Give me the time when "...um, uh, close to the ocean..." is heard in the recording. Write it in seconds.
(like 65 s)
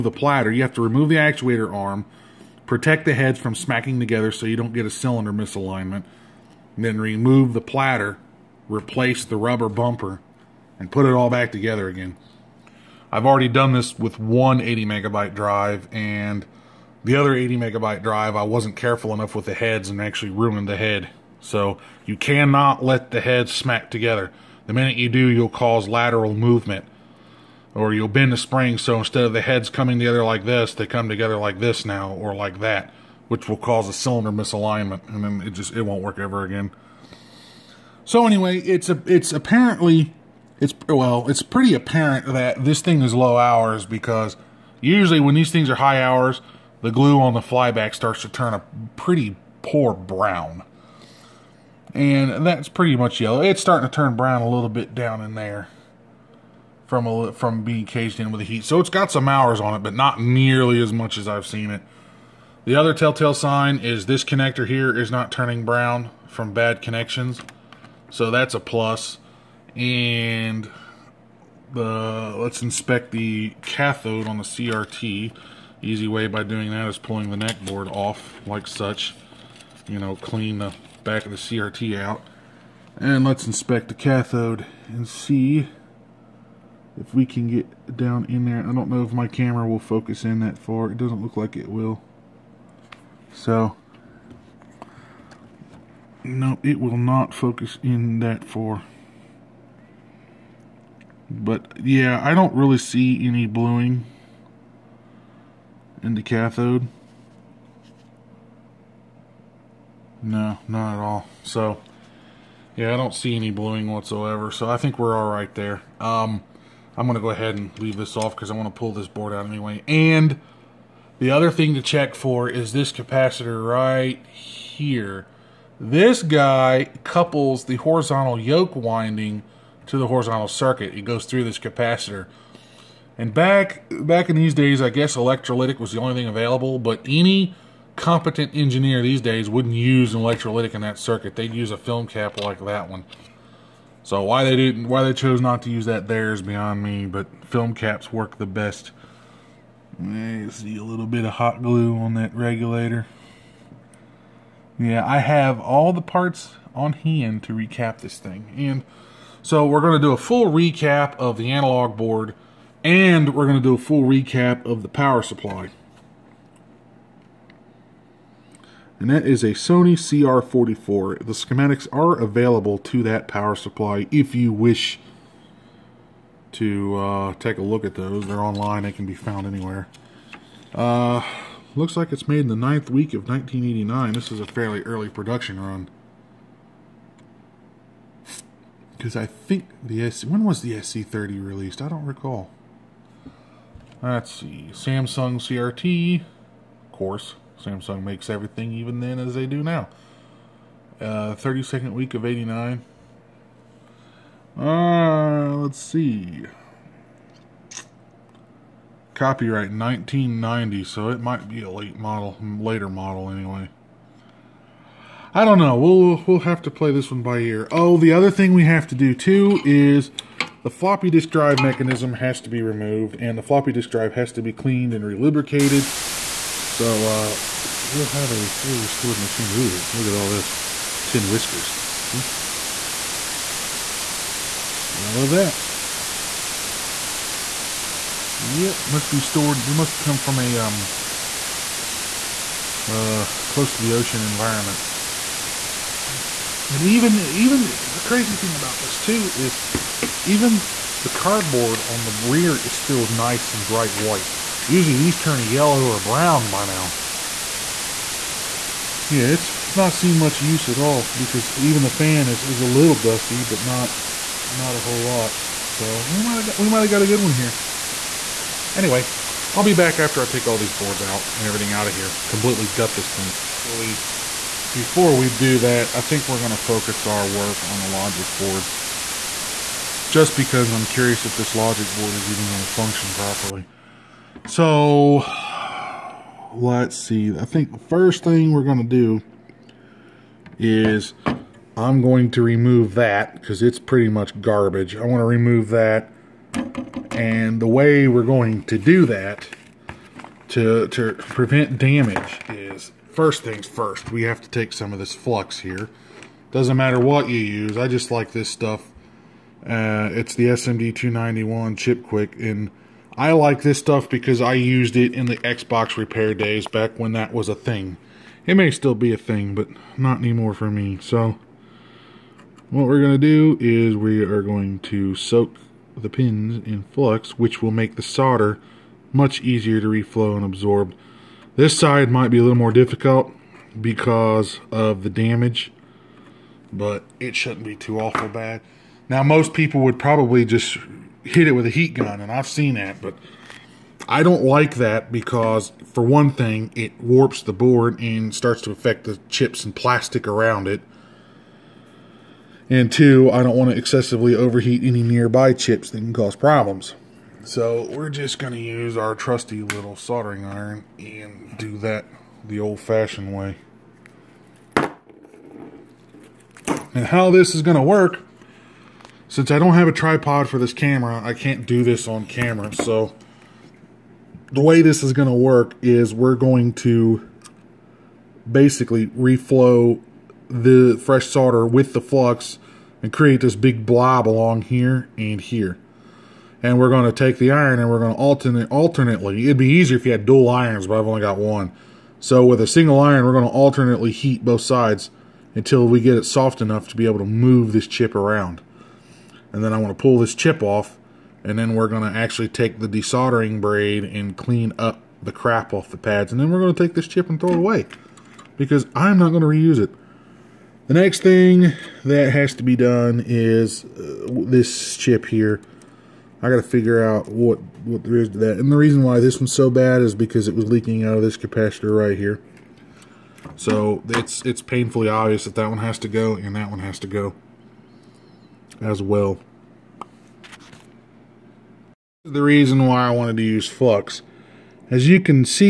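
240 s.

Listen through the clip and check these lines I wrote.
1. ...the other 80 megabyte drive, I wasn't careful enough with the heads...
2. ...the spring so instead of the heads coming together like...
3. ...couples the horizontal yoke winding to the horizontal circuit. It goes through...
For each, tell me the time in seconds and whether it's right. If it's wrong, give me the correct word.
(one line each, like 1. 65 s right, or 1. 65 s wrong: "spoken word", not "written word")
1. 17 s right
2. 28 s right
3. 127 s right.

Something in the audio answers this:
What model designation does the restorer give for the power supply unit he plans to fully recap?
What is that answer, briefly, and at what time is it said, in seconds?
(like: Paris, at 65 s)
Sony CR44, at 169 s.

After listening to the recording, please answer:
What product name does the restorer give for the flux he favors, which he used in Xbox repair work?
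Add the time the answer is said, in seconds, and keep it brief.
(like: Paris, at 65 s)
SMD 291 Chip Quik, at 310 s.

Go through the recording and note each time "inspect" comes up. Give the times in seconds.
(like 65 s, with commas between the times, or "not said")
72 s, 83 s.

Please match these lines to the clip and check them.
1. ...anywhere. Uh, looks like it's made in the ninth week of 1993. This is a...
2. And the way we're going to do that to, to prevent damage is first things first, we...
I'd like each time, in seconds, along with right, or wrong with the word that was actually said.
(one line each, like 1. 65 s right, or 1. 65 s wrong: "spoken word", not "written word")
1. 179 s wrong: "1989", not "1993"
2. 297 s right.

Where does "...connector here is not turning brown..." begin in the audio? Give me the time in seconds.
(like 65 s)
64 s.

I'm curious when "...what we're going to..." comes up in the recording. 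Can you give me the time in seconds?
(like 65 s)
322 s.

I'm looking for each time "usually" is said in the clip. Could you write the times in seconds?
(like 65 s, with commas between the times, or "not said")
44 s, 254 s.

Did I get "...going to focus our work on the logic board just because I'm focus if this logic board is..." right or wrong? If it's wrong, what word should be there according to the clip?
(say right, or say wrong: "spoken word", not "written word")
wrong: "curious", not "focus".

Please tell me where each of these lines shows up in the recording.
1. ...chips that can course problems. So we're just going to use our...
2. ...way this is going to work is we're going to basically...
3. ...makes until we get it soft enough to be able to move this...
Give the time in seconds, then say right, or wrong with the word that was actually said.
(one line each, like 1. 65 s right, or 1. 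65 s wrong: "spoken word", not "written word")
1. 355 s wrong: "cause", not "course"
2. 374 s right
3. 394 s wrong: "sides", not "makes".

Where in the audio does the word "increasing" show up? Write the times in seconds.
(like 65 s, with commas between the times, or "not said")
not said.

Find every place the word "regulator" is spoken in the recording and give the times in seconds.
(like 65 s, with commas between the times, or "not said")
152 s.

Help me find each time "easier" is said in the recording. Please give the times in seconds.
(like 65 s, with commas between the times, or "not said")
329 s, 389 s.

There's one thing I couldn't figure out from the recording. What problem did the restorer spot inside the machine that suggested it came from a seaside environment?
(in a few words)
tin whiskers.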